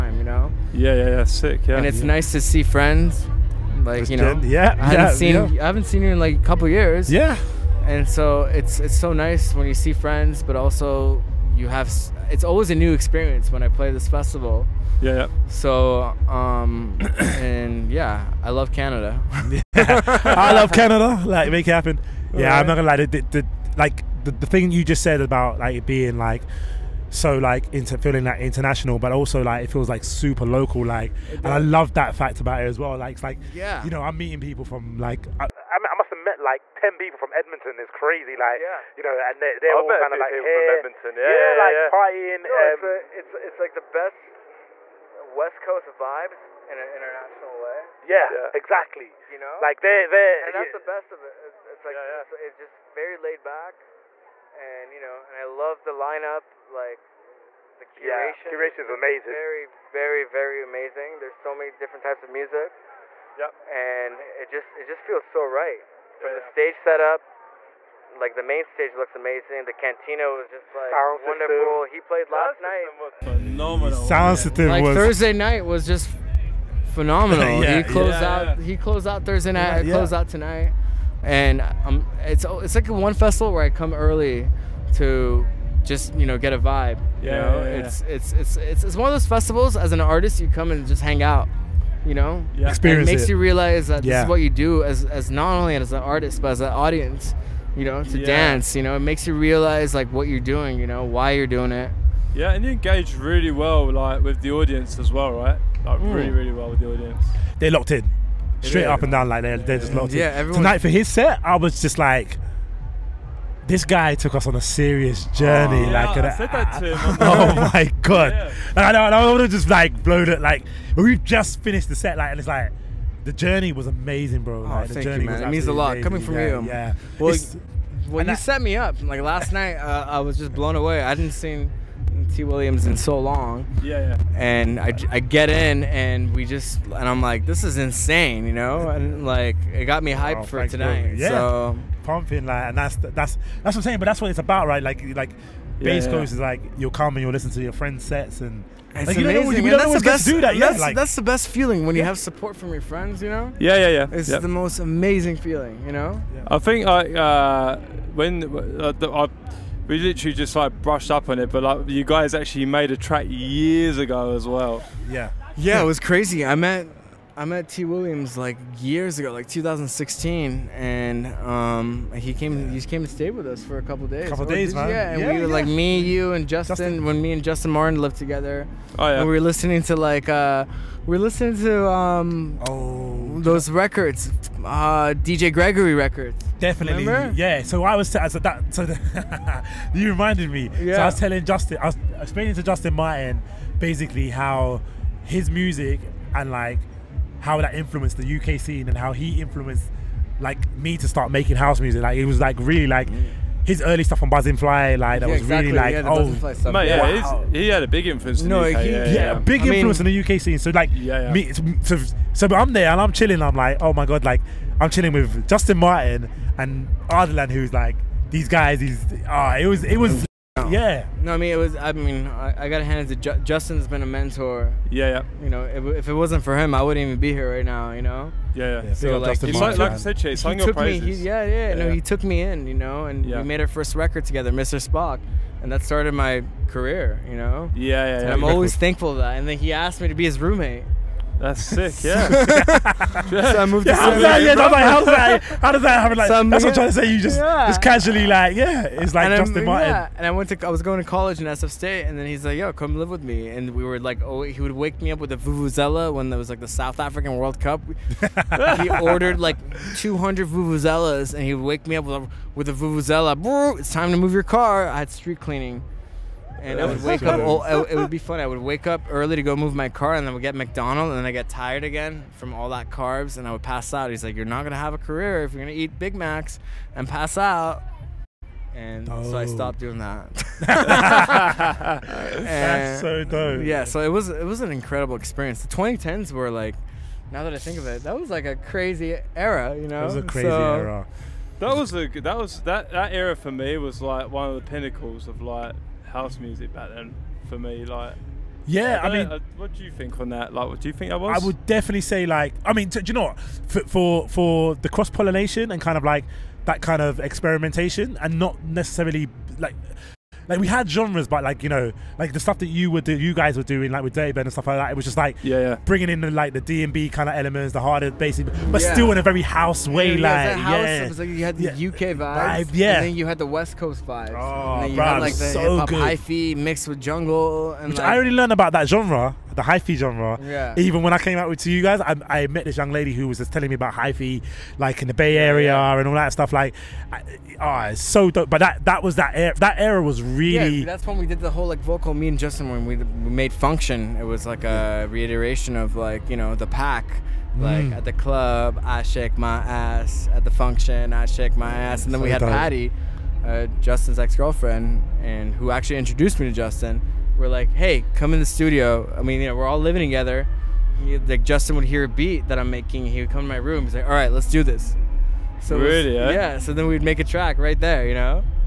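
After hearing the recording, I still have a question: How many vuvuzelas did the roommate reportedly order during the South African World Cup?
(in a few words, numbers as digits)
200.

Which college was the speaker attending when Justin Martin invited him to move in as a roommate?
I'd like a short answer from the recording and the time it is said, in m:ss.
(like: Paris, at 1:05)
SF State, at 4:11.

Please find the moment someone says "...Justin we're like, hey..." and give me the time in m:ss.
5:56.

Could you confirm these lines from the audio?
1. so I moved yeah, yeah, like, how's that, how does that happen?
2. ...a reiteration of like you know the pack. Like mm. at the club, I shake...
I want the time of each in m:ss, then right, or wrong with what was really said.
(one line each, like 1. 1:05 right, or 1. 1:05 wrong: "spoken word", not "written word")
1. 4:03 right
2. 5:44 right.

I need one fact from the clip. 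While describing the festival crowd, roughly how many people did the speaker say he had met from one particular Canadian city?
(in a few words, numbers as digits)
10.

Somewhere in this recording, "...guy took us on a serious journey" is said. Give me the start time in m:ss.
1:53.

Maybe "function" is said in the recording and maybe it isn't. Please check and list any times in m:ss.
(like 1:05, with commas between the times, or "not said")
5:43, 5:50.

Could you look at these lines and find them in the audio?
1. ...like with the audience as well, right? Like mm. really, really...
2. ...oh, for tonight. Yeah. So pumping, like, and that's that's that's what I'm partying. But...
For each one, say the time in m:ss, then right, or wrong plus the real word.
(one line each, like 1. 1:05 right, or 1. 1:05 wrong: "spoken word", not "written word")
1. 1:43 right
2. 2:20 wrong: "saying", not "partying".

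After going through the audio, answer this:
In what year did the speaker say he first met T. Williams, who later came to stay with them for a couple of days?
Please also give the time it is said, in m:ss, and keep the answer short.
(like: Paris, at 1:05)
2016, at 2:49.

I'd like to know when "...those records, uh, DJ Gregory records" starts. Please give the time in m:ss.
3:03.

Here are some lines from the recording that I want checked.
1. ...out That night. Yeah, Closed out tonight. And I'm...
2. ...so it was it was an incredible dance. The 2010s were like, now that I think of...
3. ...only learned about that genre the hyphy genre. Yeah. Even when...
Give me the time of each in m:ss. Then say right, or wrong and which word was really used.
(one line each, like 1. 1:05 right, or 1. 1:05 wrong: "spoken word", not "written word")
1. 1:19 wrong: "Thursday", not "That"
2. 4:43 wrong: "experience", not "dance"
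3. 5:28 right.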